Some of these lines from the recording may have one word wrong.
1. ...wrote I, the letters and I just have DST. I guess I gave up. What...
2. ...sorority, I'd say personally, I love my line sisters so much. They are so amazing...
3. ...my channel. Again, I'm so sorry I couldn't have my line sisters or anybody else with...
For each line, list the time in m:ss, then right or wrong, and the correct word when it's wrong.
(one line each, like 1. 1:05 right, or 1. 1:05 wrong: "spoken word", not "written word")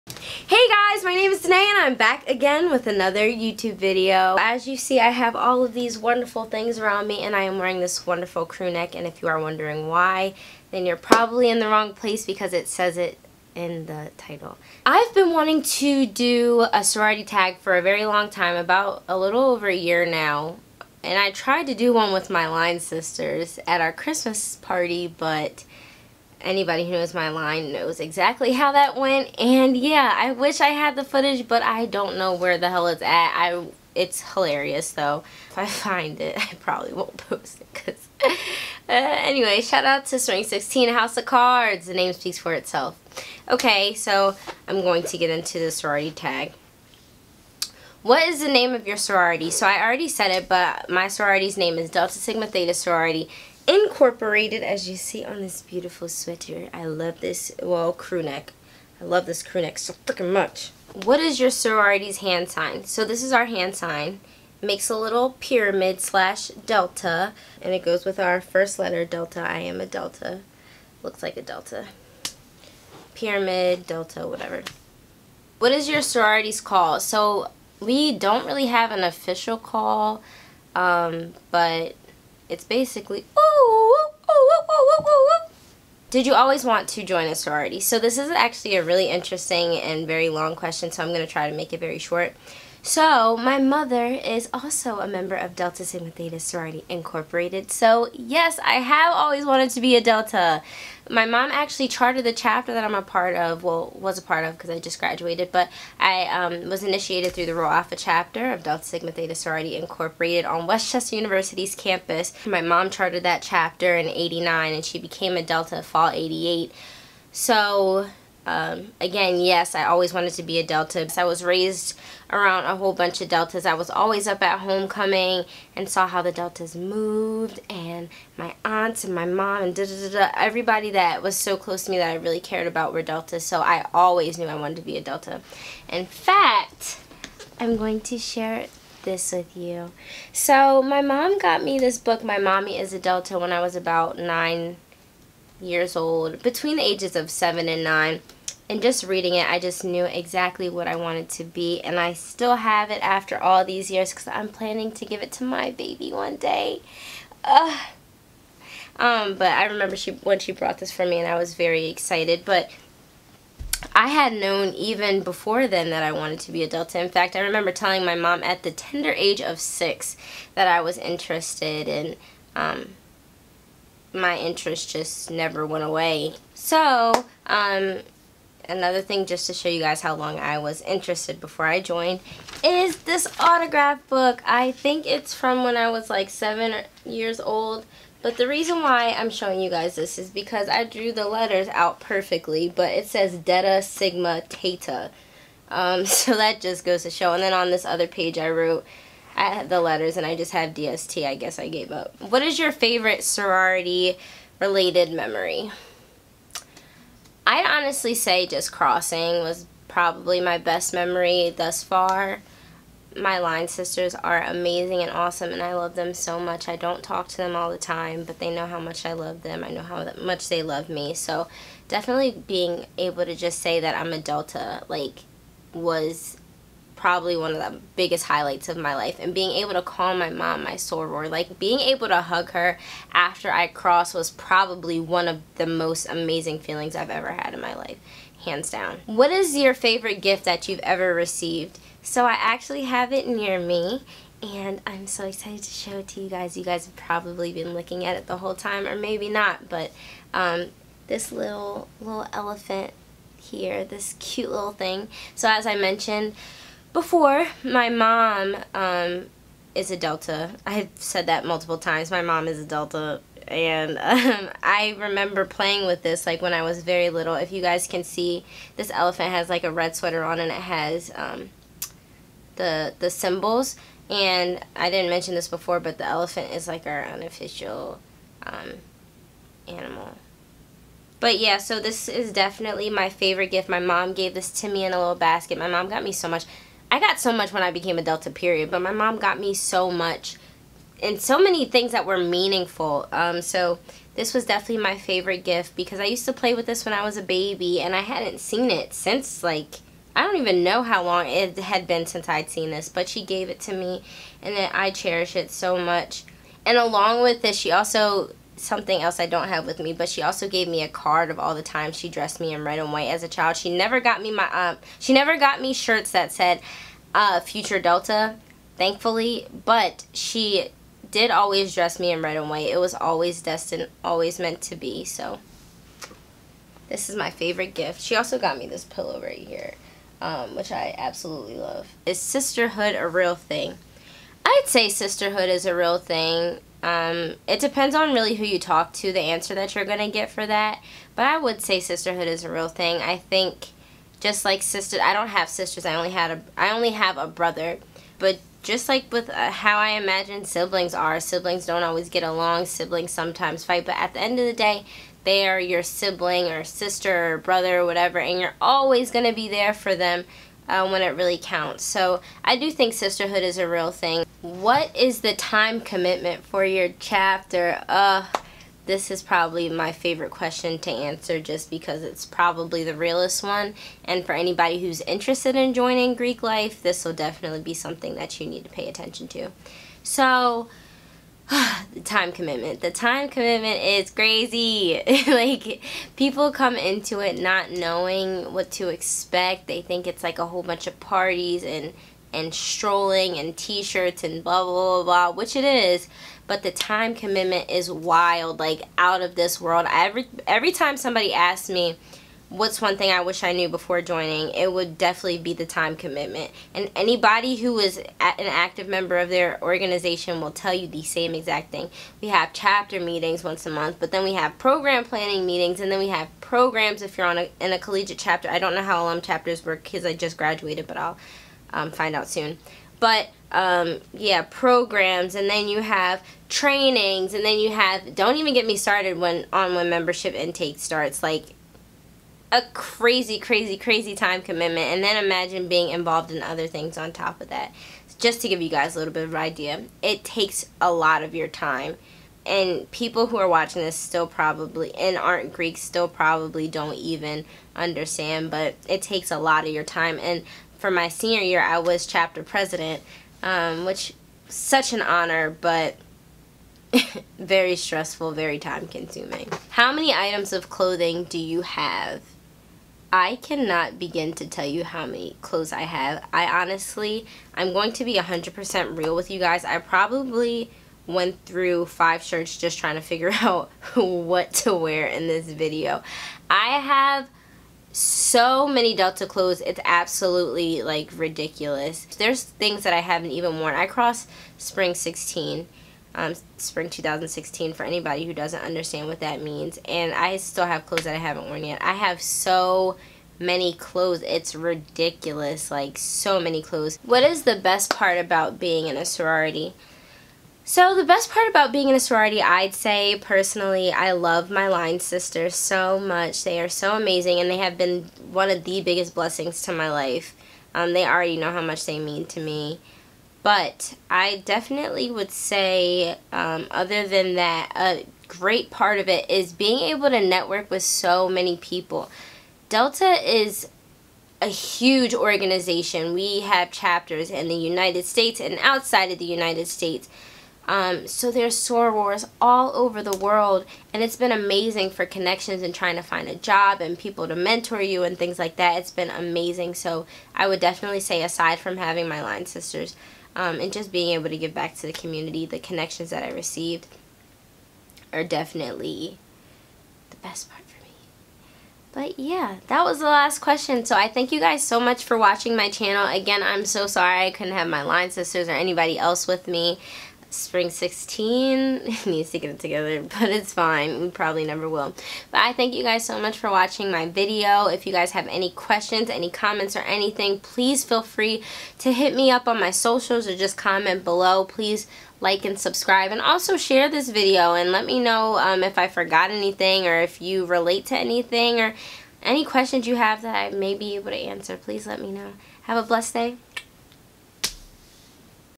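1. 3:18 right
2. 8:21 right
3. 9:15 right.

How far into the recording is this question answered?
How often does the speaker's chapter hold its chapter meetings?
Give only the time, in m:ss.
6:53.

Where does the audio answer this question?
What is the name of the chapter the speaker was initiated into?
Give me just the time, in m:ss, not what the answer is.
1:47.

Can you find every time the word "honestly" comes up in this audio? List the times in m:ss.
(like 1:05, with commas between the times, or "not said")
3:27, 7:46.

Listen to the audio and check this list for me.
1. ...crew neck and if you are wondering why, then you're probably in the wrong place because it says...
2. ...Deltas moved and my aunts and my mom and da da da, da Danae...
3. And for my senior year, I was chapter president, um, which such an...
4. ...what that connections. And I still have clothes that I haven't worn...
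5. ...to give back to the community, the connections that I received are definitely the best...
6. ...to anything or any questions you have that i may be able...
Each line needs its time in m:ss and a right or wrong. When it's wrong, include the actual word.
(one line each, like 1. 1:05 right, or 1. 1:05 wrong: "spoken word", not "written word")
1. 0:08 right
2. 2:06 wrong: "Everybody", not "Danae"
3. 7:30 right
4. 8:09 wrong: "means", not "connections"
5. 9:04 right
6. 9:40 right.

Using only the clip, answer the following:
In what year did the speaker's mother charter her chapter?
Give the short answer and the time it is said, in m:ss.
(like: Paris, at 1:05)
1989, at 1:54.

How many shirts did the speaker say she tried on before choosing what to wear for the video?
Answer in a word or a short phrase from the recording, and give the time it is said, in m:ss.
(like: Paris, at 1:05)
5, at 7:51.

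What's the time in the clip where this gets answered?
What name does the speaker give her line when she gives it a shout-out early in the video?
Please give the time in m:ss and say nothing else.
0:40.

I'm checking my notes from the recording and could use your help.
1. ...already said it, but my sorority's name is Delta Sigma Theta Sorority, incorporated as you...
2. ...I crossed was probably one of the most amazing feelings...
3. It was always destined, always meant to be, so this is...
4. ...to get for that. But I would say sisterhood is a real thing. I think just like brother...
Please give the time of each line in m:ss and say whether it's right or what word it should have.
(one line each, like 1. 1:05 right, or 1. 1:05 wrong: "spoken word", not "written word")
1. 0:49 right
2. 3:53 right
3. 5:22 right
4. 5:39 wrong: "sister", not "brother".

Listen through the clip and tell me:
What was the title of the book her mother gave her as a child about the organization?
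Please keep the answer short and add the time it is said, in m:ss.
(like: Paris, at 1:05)
My Mommy is a Delta, at 2:22.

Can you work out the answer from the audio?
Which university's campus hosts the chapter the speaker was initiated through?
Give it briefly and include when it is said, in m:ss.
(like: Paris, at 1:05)
West Chester University, at 1:50.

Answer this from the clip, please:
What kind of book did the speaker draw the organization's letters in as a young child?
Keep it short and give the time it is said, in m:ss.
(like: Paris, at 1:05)
autograph book, at 3:03.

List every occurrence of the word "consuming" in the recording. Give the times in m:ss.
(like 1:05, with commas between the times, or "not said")
7:38.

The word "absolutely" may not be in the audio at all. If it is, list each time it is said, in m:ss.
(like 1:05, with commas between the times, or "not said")
5:30, 7:59.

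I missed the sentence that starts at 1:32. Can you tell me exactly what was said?
So my mother is also a member of Delta Sigma Theta Sorority Incorporated.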